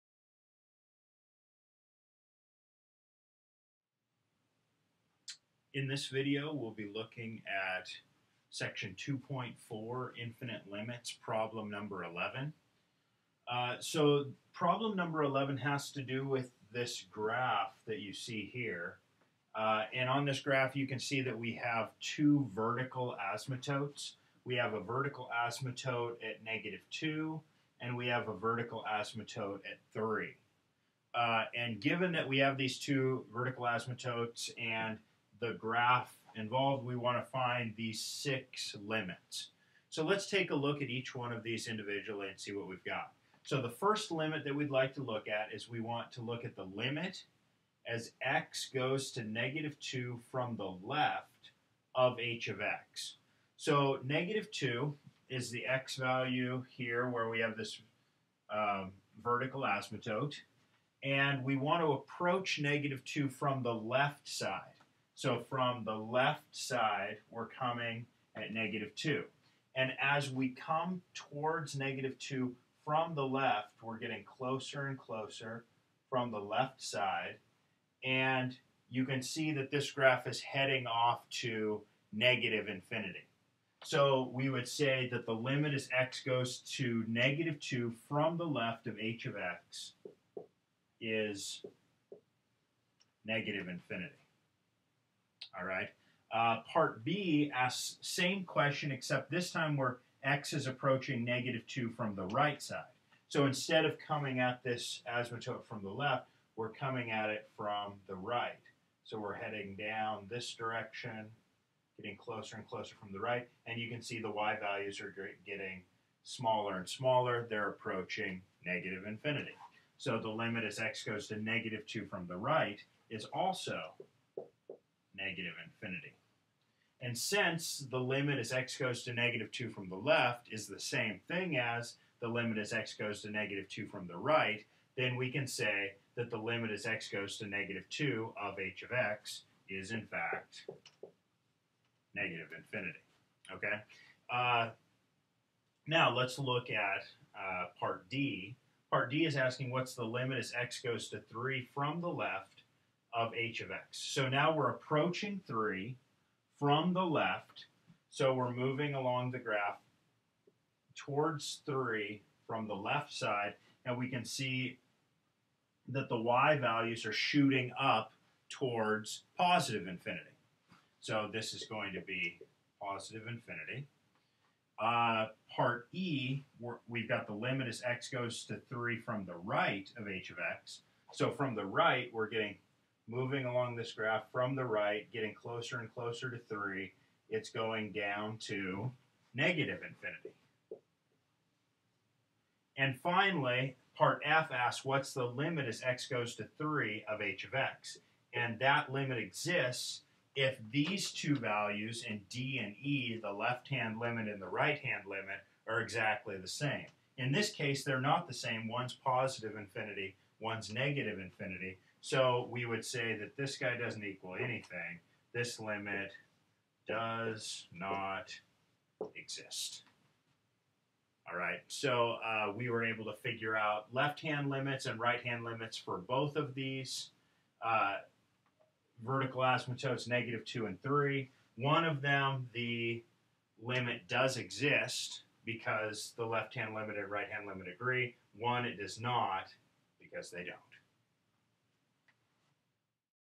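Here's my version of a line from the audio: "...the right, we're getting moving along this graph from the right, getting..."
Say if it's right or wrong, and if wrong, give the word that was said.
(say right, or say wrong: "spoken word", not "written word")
right.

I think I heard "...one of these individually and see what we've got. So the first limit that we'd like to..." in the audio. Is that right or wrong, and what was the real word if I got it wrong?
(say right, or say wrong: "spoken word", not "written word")
right.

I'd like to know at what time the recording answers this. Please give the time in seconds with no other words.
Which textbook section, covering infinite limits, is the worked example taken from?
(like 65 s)
8 s.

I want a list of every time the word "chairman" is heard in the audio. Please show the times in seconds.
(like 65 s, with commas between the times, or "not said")
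not said.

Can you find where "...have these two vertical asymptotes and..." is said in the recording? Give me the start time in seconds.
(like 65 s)
32 s.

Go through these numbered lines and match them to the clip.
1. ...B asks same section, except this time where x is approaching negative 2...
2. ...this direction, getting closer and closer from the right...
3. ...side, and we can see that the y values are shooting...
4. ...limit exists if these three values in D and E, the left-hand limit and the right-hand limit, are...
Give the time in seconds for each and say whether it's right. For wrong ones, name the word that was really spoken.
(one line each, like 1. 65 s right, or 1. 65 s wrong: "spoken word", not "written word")
1. 97 s wrong: "question", not "section"
2. 110 s right
3. 163 s right
4. 198 s wrong: "two", not "three".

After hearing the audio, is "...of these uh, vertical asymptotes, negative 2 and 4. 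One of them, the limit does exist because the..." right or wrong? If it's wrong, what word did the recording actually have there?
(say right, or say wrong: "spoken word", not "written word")
wrong: "3", not "4".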